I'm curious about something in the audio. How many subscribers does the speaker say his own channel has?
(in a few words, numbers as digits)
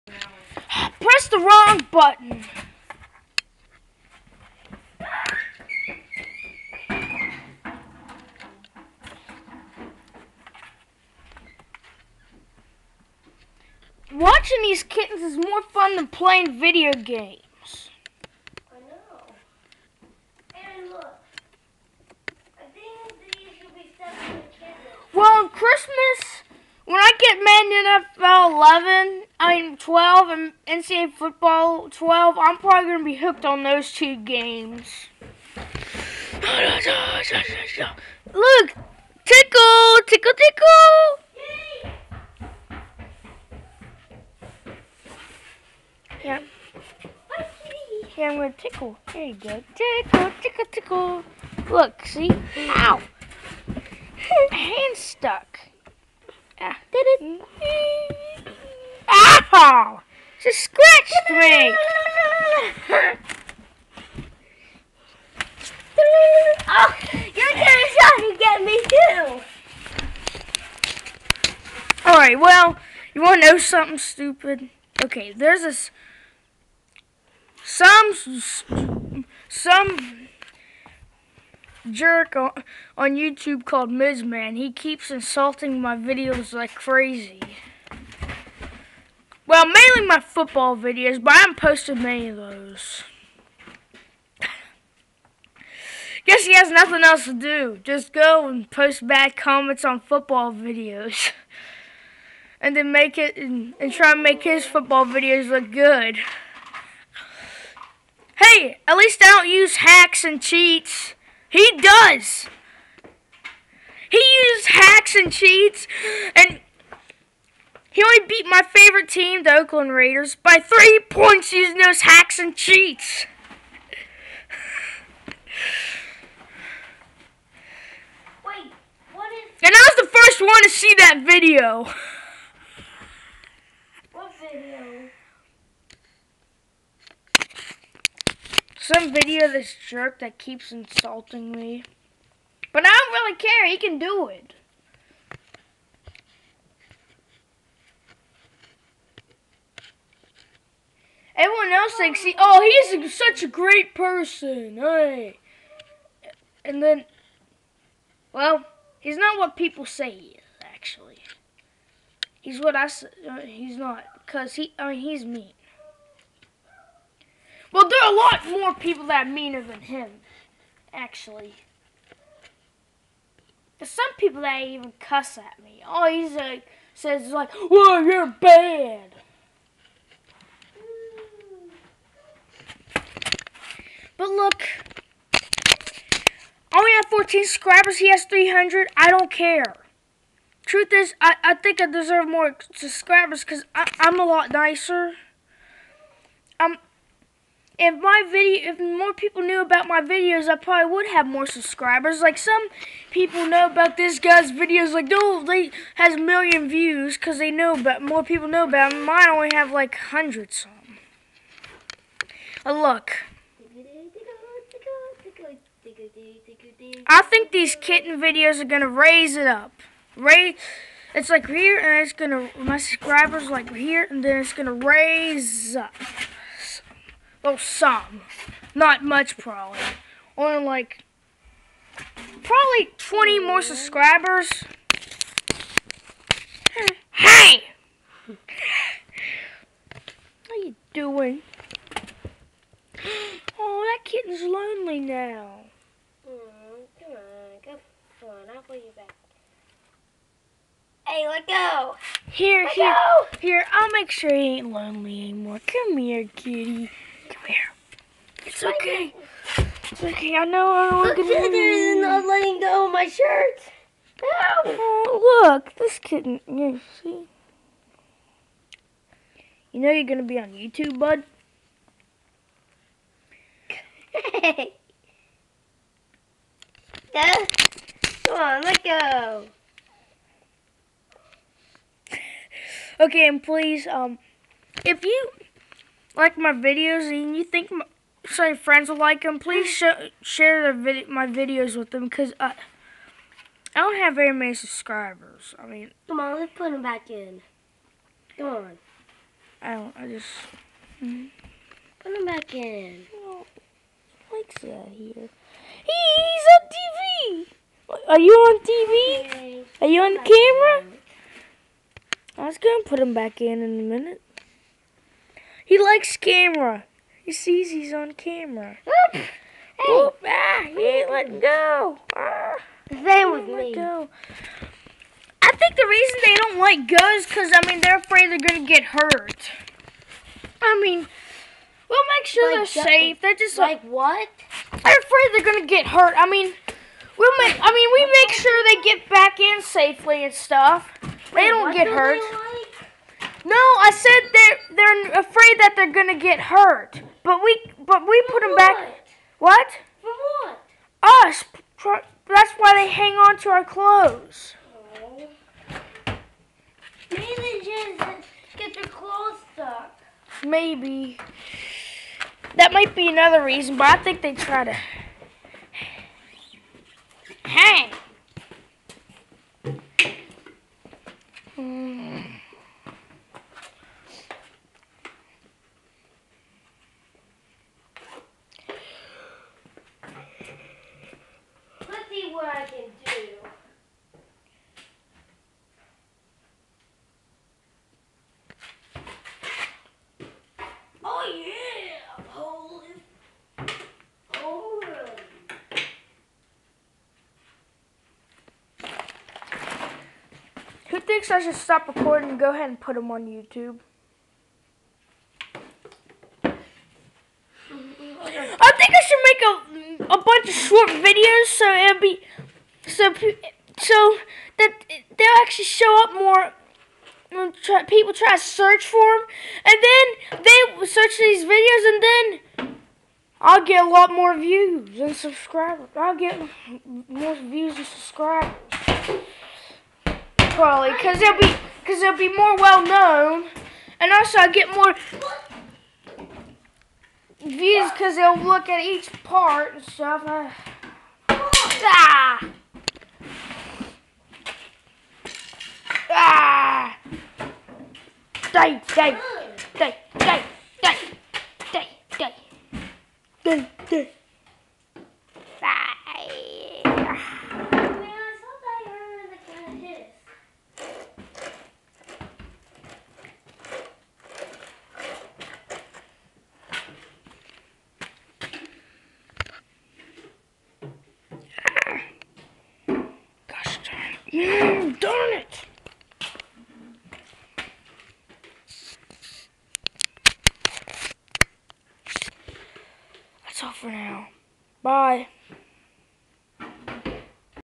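14.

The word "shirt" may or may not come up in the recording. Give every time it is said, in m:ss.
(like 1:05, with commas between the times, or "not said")
4:23.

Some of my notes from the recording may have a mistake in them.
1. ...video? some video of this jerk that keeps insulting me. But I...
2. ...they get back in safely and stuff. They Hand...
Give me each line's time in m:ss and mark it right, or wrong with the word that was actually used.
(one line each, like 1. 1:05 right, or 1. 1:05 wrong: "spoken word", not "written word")
1. 2:14 right
2. 5:38 wrong: "Wait", not "Hand".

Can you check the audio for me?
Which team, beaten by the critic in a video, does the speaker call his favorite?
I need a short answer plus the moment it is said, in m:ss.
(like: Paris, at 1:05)
Oakland Raiders, at 1:59.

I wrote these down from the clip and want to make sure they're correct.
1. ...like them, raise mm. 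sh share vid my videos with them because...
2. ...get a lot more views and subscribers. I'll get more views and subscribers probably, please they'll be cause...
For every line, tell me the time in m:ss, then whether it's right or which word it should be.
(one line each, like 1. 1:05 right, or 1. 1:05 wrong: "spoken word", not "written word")
1. 4:48 wrong: "please", not "raise"
2. 7:03 wrong: "cause", not "please".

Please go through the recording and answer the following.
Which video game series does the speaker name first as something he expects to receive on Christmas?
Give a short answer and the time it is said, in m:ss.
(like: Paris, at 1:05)
Madden NFL, at 0:28.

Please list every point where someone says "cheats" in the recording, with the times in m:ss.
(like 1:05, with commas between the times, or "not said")
1:50, 1:55, 2:02.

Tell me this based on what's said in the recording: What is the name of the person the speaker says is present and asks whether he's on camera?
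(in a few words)
Mike.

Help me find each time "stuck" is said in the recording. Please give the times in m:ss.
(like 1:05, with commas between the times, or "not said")
0:54, 5:59.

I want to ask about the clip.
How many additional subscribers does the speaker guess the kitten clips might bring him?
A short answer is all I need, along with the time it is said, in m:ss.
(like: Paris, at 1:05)
20, at 3:52.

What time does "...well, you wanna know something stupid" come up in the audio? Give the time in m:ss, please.
1:12.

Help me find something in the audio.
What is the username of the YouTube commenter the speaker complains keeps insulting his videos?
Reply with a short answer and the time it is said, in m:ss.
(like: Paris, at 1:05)
Mizman, at 1:23.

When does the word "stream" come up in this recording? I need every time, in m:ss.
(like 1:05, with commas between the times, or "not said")
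not said.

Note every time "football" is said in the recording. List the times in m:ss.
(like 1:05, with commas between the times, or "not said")
0:31, 1:30, 1:39, 1:44.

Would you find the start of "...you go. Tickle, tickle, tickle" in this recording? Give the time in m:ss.
0:49.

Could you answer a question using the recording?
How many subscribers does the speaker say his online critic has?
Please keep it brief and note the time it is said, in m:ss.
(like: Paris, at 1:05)
300, at 3:08.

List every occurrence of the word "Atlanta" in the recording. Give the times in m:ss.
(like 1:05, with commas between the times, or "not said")
not said.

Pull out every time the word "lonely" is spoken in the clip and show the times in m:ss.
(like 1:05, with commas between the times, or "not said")
4:04, 4:14.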